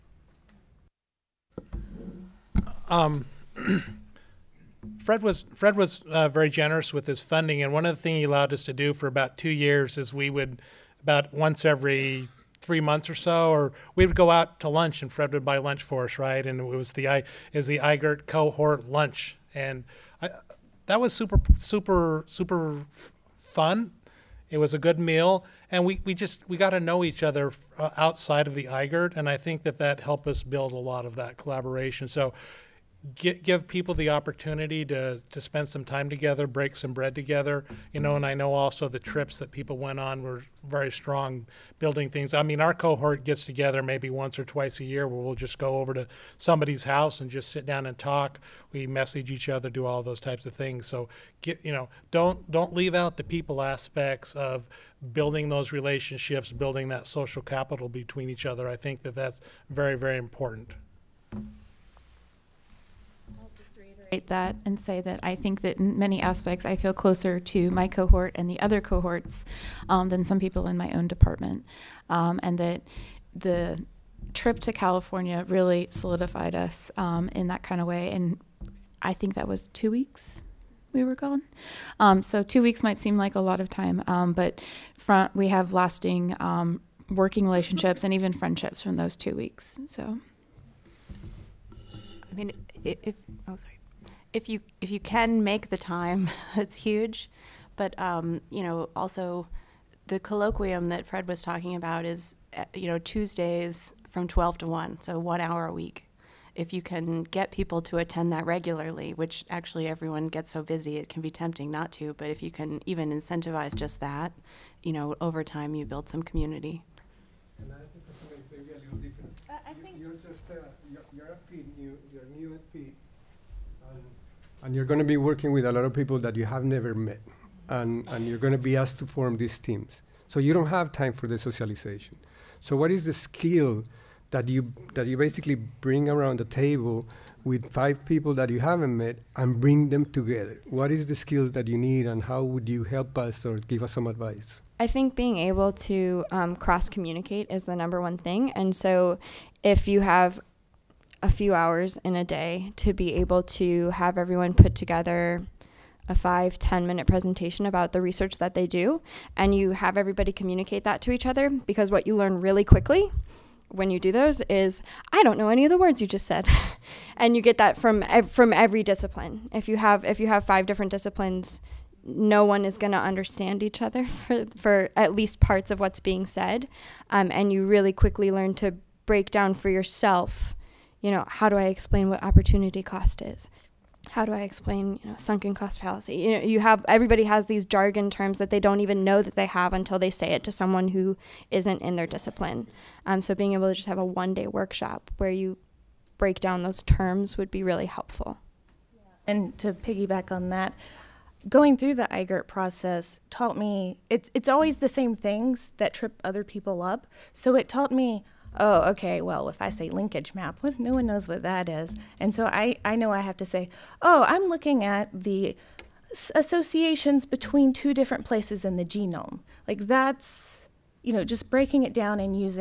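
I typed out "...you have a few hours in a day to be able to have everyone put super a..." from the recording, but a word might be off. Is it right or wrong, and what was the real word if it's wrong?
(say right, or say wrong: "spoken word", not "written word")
wrong: "together", not "super".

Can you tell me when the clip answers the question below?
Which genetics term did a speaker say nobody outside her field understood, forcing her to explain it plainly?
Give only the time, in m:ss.
3:29.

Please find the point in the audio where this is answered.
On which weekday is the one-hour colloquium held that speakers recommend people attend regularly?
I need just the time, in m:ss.
1:42.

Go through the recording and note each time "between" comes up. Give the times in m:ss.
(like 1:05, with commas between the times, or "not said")
0:57, 3:37.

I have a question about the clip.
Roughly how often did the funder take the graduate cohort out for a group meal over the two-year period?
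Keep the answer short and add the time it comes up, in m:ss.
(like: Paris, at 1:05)
Once every three months, at 0:11.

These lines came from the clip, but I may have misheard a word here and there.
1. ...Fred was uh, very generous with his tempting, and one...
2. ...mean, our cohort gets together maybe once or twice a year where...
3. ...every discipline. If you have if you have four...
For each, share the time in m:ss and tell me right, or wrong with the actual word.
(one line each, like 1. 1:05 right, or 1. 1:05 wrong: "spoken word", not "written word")
1. 0:05 wrong: "funding", not "tempting"
2. 0:42 right
3. 2:48 wrong: "five", not "four".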